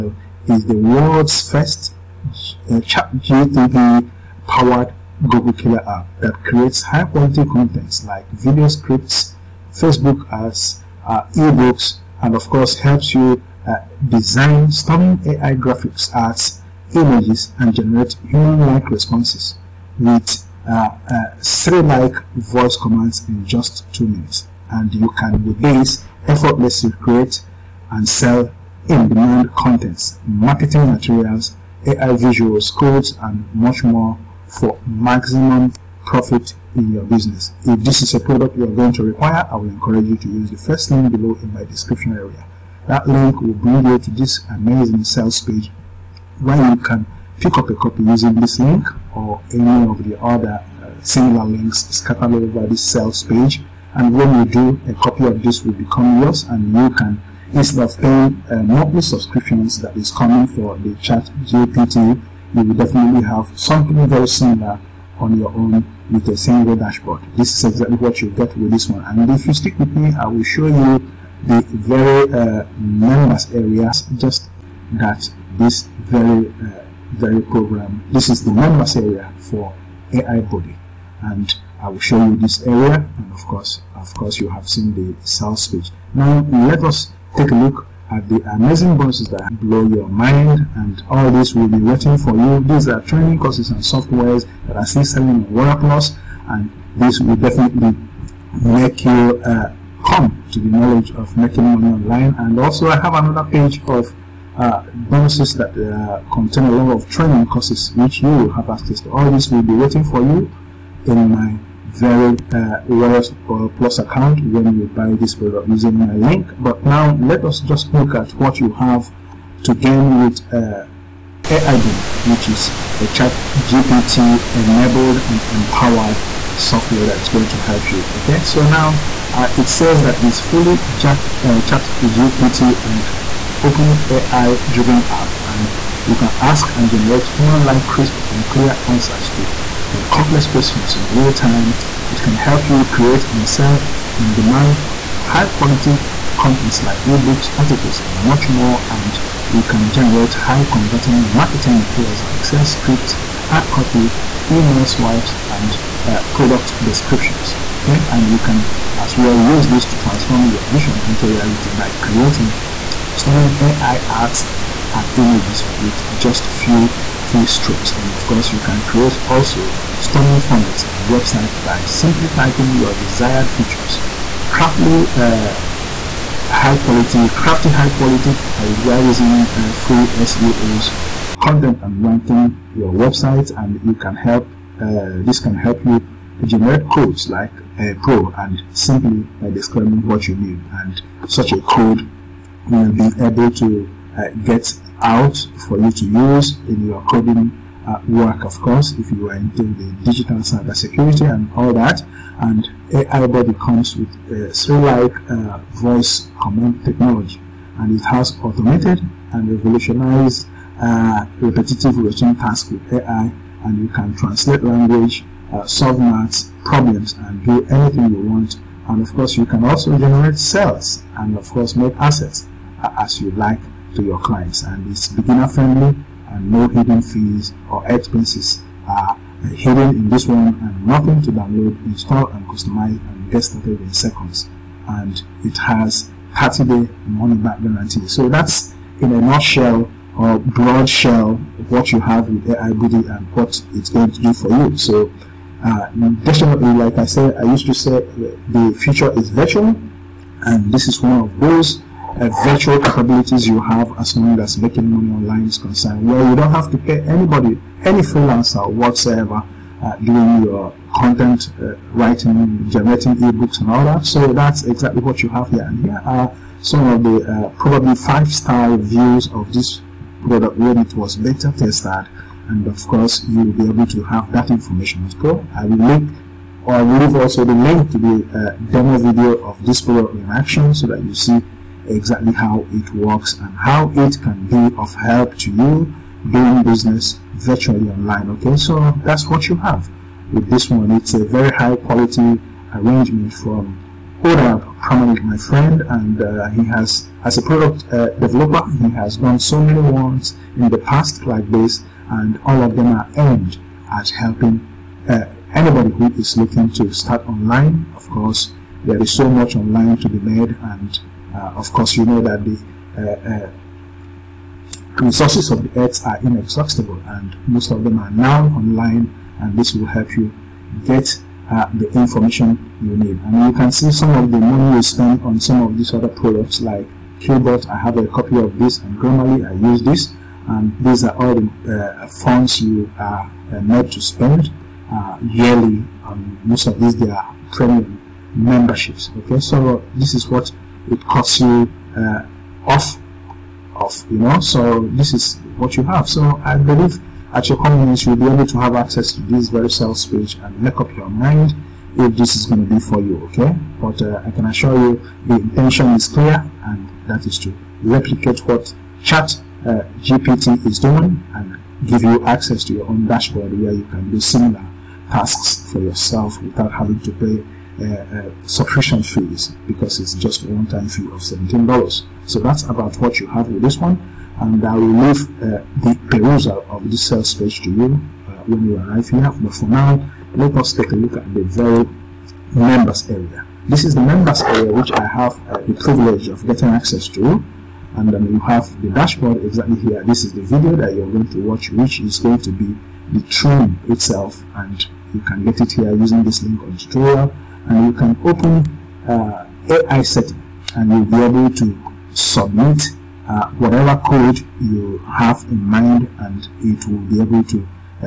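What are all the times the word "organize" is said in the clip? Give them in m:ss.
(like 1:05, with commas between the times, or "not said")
not said.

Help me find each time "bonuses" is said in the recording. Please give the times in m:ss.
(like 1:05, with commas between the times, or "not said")
1:28, 1:45.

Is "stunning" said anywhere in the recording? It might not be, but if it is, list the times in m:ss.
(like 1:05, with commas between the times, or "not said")
0:14, 2:43.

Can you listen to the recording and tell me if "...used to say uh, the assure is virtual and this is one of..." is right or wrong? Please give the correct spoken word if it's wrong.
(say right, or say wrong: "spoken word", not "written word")
wrong: "future", not "assure".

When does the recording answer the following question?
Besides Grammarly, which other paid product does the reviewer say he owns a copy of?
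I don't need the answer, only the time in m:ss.
5:27.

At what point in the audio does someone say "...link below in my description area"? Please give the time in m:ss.
0:40.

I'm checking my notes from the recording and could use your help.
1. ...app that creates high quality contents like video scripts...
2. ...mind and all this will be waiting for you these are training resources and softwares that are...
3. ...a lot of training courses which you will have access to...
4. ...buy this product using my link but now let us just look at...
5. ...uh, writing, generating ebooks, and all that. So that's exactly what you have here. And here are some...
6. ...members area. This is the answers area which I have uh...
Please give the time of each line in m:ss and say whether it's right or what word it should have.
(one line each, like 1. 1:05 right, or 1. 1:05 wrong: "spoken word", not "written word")
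1. 0:05 right
2. 1:30 wrong: "courses", not "resources"
3. 1:46 right
4. 1:54 right
5. 4:21 right
6. 6:22 wrong: "members", not "answers".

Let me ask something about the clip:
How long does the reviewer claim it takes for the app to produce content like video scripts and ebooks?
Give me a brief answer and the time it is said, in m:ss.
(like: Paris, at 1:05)
2 minutes, at 0:23.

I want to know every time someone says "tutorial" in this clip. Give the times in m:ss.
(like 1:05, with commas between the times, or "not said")
6:36.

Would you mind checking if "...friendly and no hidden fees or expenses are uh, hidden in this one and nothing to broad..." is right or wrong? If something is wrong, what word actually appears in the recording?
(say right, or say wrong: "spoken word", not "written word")
wrong: "download", not "broad".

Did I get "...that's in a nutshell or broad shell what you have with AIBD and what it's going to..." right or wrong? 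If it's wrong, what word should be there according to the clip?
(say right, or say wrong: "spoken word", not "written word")
right.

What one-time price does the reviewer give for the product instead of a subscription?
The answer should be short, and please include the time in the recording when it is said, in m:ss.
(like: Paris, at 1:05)
$17, at 6:11.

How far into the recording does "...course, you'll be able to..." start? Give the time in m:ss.
4:32.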